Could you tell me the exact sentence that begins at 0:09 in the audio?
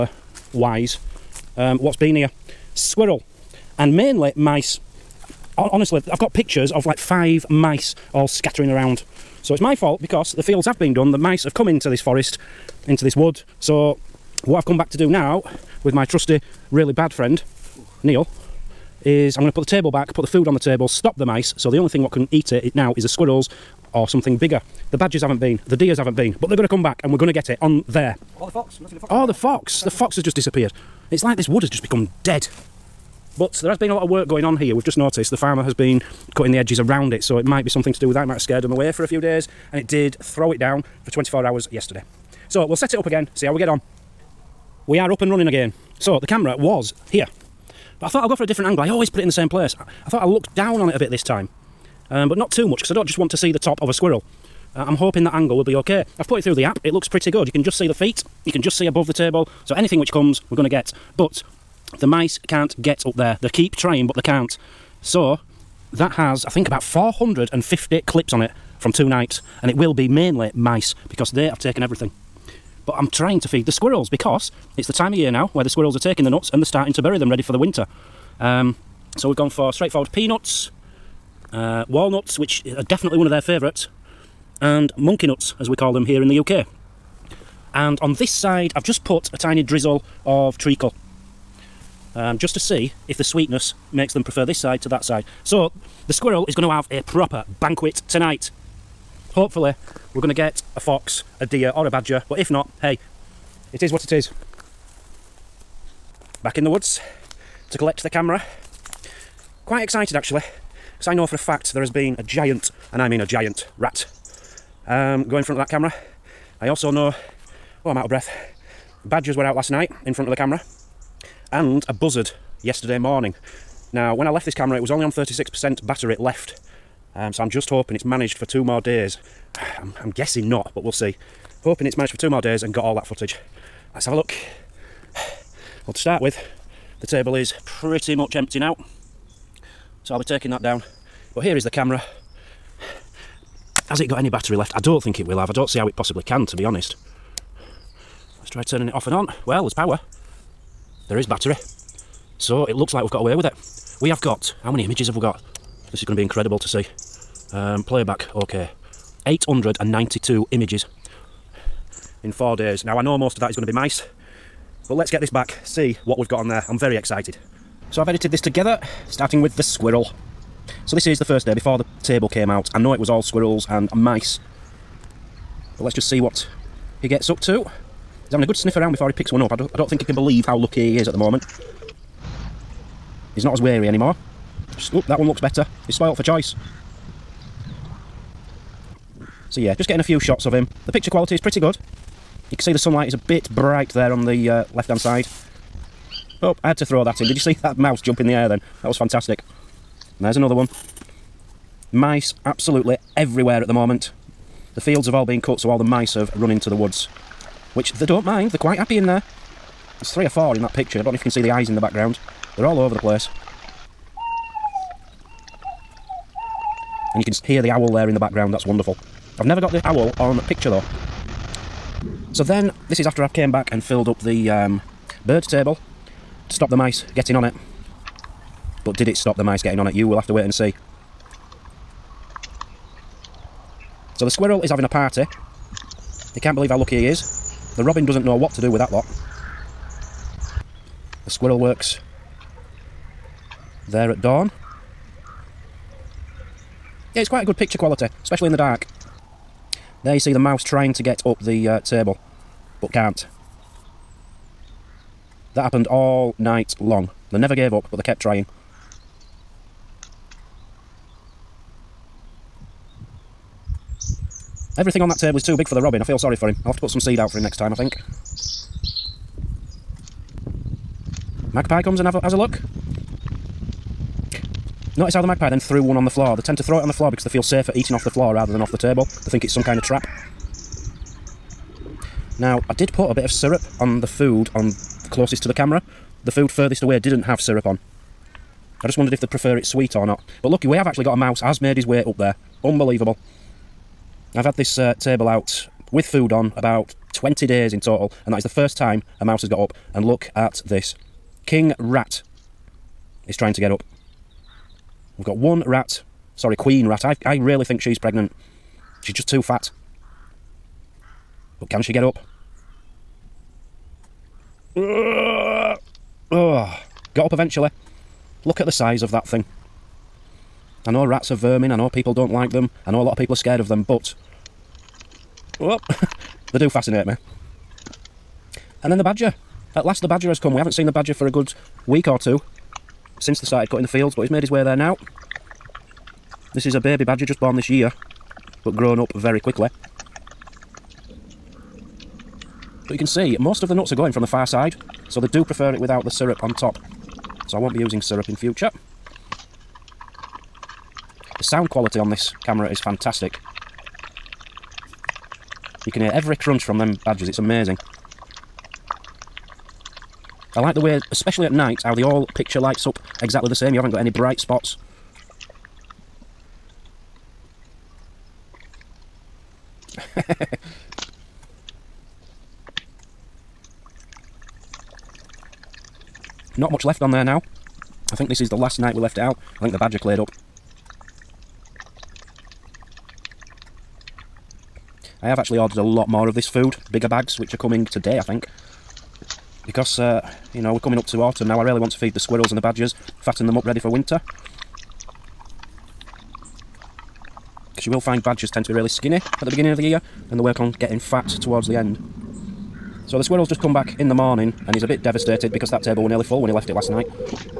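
So it's my fault because the fields have been done, the mice have come into this forest, into this wood.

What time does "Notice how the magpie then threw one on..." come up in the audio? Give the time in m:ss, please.
4:34.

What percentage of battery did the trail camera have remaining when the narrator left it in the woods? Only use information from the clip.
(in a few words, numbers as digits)
36%.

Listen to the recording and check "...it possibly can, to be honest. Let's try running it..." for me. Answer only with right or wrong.
wrong.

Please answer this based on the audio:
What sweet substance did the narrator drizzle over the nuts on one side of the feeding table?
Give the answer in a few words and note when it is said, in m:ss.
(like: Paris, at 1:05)
Treacle, at 1:30.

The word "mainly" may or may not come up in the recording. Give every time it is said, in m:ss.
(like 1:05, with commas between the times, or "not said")
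0:03, 1:10.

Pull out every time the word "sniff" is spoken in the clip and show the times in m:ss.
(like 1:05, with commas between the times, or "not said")
2:58.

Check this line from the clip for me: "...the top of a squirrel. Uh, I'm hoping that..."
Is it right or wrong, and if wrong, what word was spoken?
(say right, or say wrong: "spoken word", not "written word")
right.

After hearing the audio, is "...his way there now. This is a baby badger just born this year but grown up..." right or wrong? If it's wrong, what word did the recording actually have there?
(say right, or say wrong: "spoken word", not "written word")
right.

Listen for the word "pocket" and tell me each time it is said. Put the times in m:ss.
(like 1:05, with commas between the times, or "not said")
not said.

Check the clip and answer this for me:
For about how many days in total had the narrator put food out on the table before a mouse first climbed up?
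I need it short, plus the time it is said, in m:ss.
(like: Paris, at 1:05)
20 days, at 4:57.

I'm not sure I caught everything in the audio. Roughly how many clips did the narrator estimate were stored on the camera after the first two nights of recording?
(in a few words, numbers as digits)
450.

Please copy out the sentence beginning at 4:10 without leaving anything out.
There you see the mouse trying to get up the uh, table, but can't.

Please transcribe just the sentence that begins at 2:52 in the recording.
I know it was all squirrels and mice.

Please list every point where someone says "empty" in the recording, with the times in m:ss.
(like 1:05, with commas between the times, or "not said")
2:18.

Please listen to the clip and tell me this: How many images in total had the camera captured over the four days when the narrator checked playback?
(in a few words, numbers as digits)
892.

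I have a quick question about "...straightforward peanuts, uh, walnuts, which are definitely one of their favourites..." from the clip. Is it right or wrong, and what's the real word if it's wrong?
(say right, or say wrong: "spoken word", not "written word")
right.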